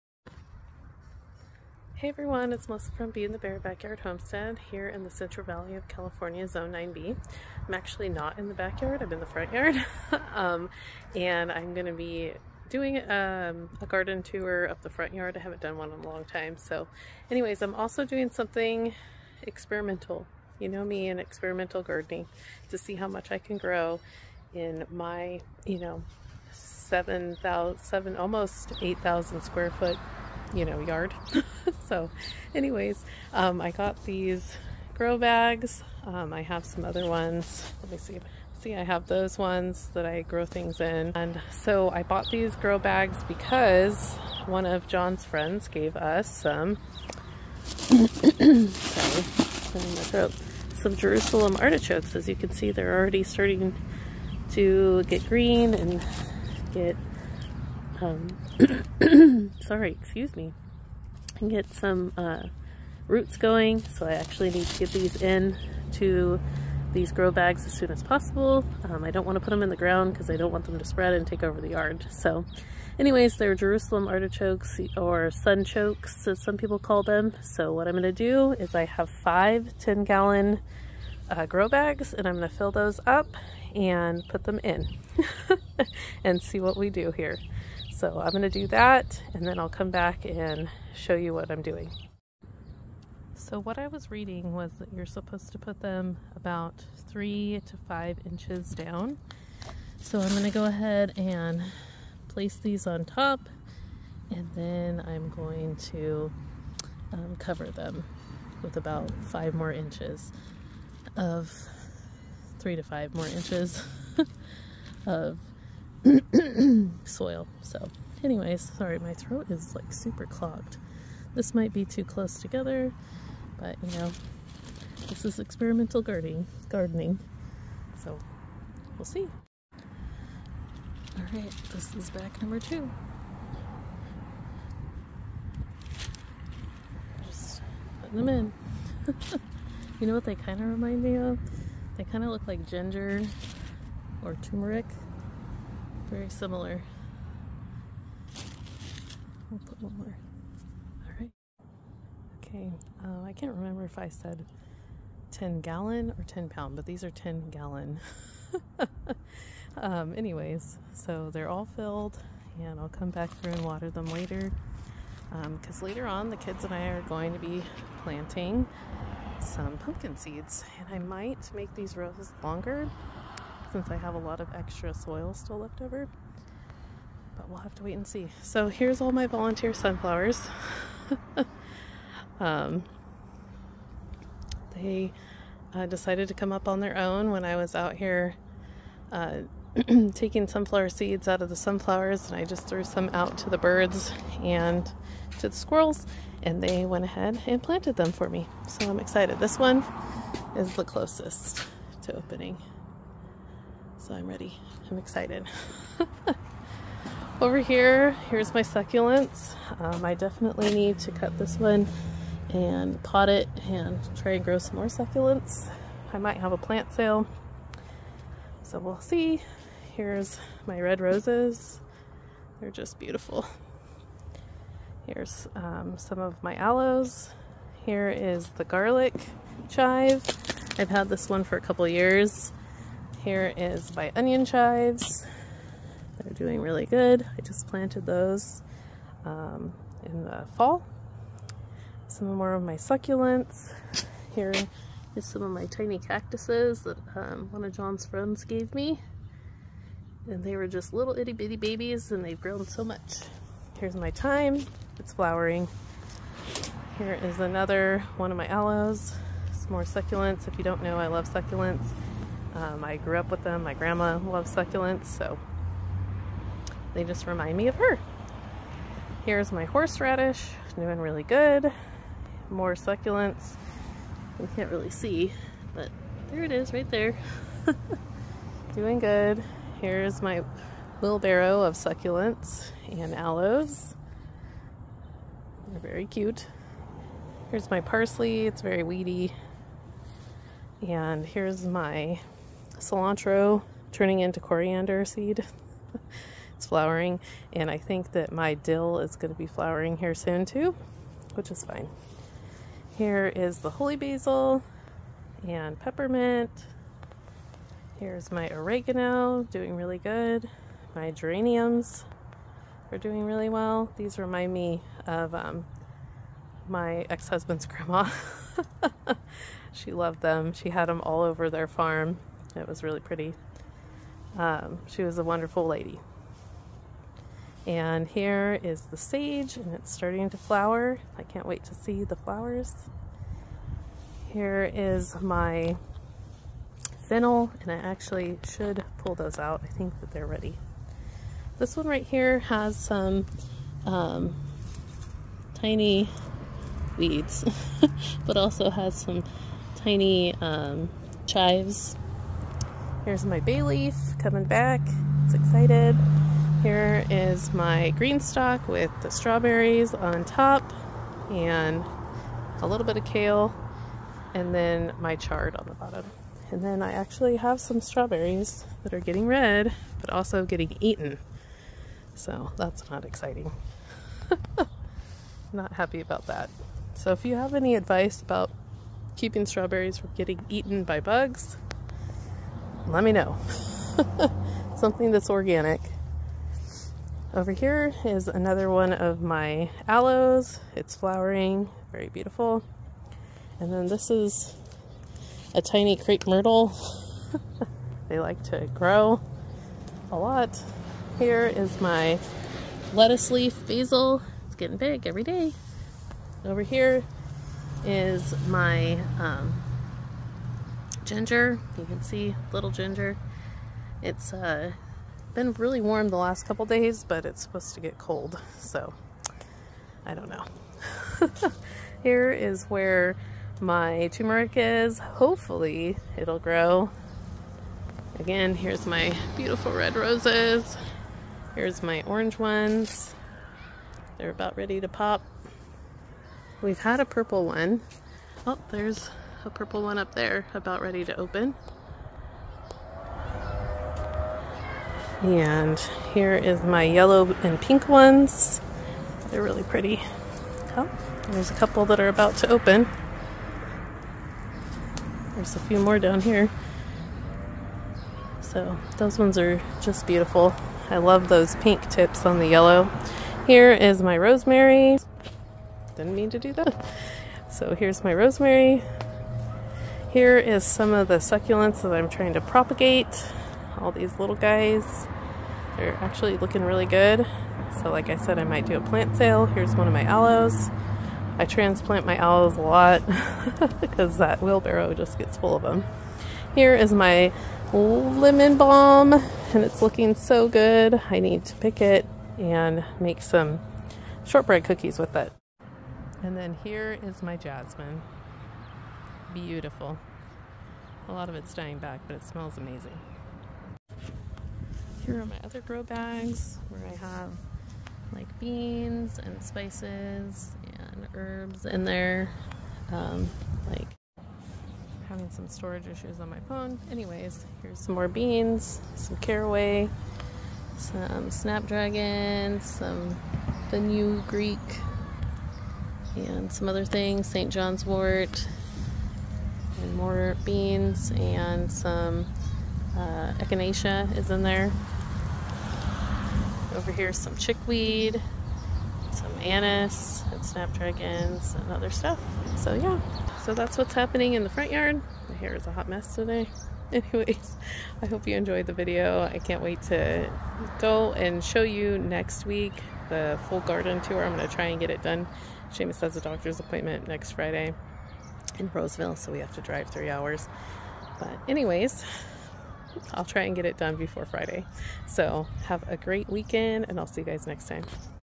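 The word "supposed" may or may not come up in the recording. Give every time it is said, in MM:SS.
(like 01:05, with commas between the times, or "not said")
01:35, 06:57.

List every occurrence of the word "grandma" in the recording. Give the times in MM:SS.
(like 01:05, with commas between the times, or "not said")
04:23, 05:17.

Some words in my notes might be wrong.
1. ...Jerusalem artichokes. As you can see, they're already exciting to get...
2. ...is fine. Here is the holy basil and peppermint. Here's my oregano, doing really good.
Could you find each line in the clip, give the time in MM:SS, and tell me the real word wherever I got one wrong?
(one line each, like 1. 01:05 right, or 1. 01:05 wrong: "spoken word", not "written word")
1. 00:50 wrong: "starting", not "exciting"
2. 05:01 right.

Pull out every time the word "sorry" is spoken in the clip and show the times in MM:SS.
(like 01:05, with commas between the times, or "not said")
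00:47, 00:59, 01:58.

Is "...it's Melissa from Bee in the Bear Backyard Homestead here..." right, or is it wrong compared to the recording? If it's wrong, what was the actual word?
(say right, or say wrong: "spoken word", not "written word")
right.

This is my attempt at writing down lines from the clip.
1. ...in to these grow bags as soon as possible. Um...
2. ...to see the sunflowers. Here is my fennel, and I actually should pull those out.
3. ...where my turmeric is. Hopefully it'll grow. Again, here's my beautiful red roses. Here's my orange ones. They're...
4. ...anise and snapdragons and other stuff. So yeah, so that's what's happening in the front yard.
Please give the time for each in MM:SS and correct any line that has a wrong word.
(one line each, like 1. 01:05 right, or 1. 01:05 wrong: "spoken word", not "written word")
1. 01:05 right
2. 05:31 wrong: "flowers", not "sunflowers"
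3. 07:02 right
4. 08:59 right.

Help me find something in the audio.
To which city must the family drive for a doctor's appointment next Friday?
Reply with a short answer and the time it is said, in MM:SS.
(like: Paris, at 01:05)
Roseville, at 09:18.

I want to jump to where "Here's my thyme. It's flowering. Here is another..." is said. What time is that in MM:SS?
04:13.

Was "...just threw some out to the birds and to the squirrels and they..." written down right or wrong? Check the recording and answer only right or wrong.
right.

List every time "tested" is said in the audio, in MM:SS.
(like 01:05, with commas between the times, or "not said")
not said.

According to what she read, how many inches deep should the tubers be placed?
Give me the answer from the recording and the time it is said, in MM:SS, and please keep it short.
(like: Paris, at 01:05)
3 to 5 inches, at 01:37.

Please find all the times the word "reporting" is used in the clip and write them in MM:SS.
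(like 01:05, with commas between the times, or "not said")
not said.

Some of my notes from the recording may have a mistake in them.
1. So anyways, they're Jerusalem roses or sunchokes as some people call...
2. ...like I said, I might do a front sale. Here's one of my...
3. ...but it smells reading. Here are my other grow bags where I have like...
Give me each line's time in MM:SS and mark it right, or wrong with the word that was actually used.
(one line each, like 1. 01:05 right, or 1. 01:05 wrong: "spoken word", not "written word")
1. 01:12 wrong: "artichokes", not "roses"
2. 07:57 wrong: "plant", not "front"
3. 08:22 wrong: "amazing", not "reading".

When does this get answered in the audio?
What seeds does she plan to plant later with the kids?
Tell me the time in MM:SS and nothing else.
02:49.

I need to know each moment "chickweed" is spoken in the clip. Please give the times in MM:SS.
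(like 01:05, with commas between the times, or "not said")
08:57.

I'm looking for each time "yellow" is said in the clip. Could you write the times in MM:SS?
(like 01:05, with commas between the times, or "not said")
07:26, 07:42.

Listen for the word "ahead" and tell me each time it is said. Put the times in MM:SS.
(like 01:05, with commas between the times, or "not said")
01:40, 03:17.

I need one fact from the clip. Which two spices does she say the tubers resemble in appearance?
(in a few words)
ginger or turmeric.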